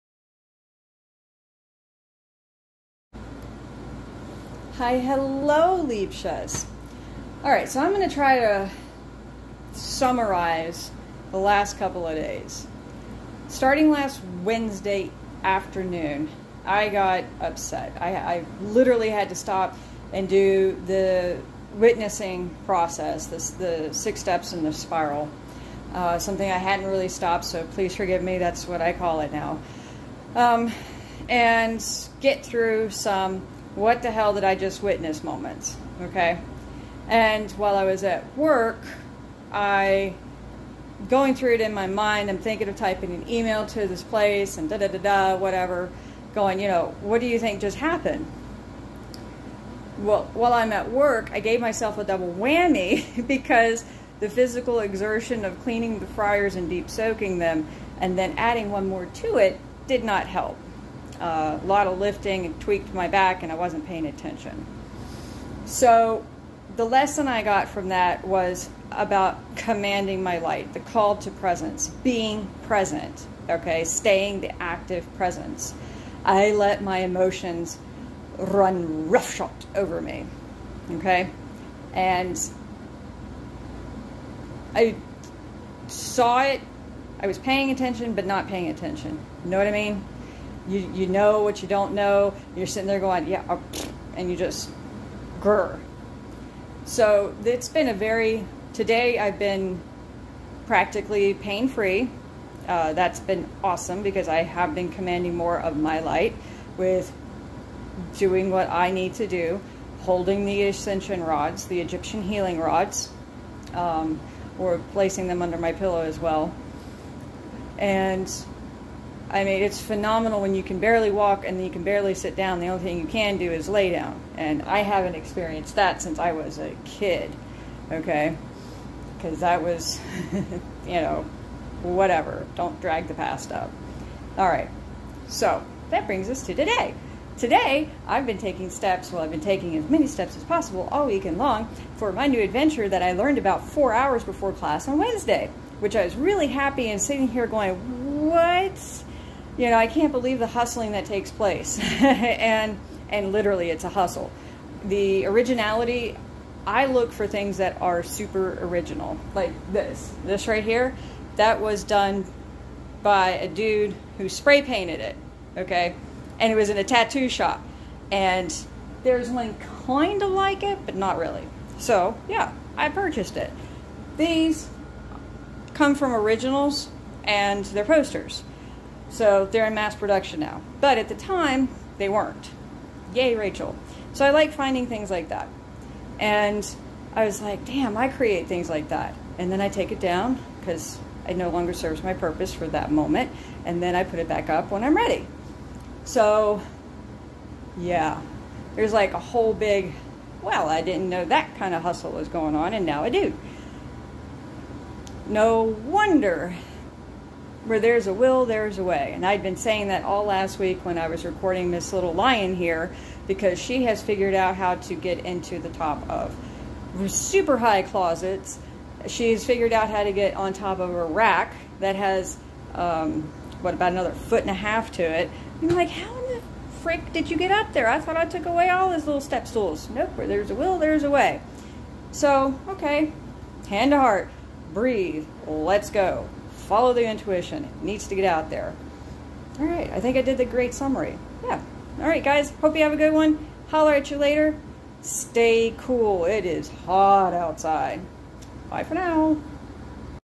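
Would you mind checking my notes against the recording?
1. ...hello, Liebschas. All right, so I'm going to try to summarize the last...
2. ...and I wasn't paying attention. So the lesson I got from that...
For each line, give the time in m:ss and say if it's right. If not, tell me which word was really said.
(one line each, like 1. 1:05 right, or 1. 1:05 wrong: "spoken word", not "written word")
1. 0:04 right
2. 1:03 right.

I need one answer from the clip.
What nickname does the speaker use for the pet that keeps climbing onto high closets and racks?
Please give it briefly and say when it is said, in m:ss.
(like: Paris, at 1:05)
Miss Little Lion, at 3:31.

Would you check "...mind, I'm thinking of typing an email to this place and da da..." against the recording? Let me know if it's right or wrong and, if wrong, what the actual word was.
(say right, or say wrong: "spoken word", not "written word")
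right.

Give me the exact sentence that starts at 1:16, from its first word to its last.
I let my emotions run roughshod over me, okay?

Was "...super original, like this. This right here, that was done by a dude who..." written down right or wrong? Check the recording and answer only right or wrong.
right.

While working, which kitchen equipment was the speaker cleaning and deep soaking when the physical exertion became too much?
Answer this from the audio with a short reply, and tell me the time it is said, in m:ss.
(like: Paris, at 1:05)
fryers, at 0:56.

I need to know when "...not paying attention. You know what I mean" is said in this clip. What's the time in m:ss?
1:28.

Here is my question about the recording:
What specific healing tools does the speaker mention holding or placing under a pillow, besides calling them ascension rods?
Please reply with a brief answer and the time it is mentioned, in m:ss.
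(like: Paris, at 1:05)
Egyptian healing rods, at 1:51.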